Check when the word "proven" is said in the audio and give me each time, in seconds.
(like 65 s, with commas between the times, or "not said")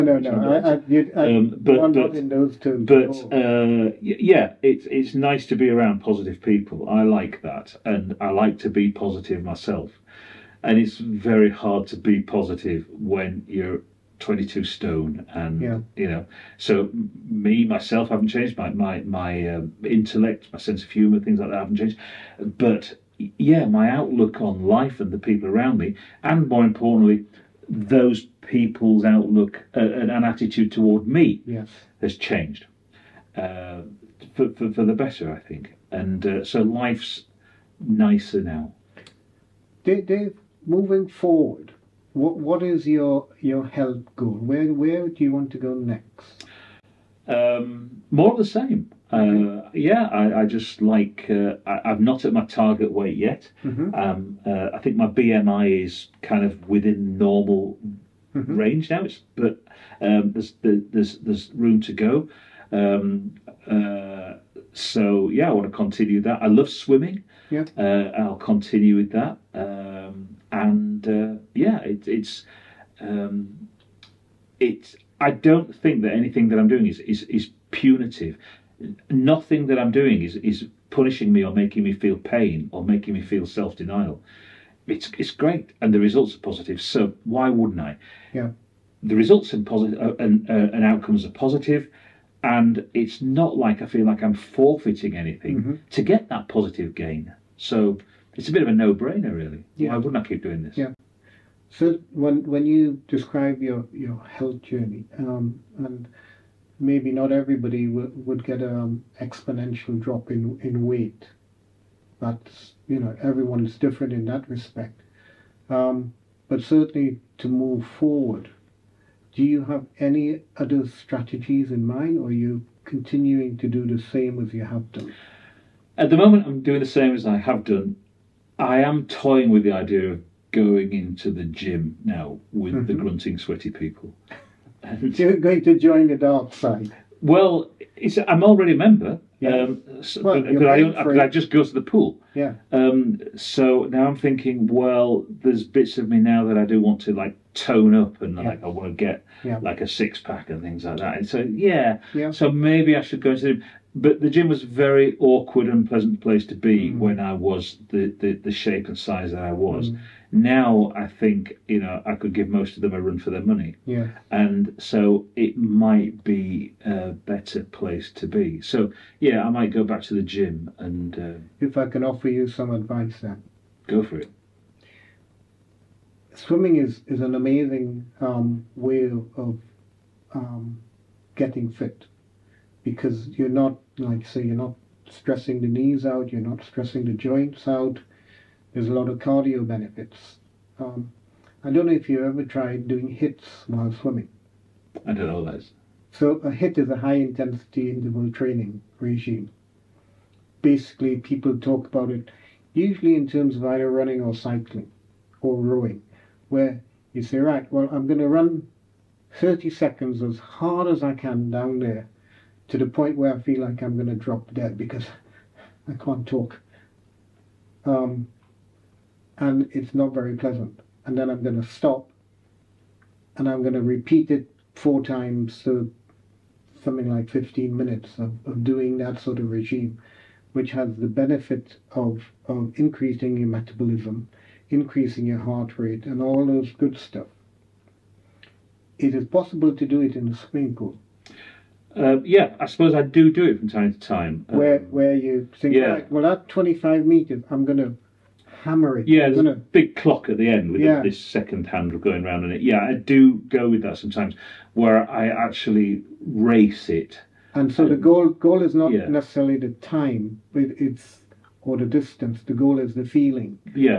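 not said.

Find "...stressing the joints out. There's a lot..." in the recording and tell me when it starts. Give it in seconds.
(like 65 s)
186 s.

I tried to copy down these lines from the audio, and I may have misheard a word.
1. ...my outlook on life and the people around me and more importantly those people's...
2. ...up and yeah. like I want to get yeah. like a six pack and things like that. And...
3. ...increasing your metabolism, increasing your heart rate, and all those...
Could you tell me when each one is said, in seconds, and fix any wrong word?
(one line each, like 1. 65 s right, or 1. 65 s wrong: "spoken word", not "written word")
1. 23 s right
2. 147 s right
3. 232 s right.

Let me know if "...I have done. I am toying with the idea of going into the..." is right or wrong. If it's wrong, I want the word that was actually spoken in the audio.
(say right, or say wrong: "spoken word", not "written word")
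right.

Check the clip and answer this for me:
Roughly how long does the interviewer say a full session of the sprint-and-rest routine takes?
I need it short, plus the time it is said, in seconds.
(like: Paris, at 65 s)
15 minutes, at 227 s.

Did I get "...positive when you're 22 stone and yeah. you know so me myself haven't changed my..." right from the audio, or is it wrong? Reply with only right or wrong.
right.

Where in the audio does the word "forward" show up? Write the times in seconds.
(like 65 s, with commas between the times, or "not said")
41 s, 117 s.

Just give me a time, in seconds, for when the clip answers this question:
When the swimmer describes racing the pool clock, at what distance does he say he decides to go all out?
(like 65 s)
246 s.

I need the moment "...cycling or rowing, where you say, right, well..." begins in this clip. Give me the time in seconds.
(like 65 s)
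204 s.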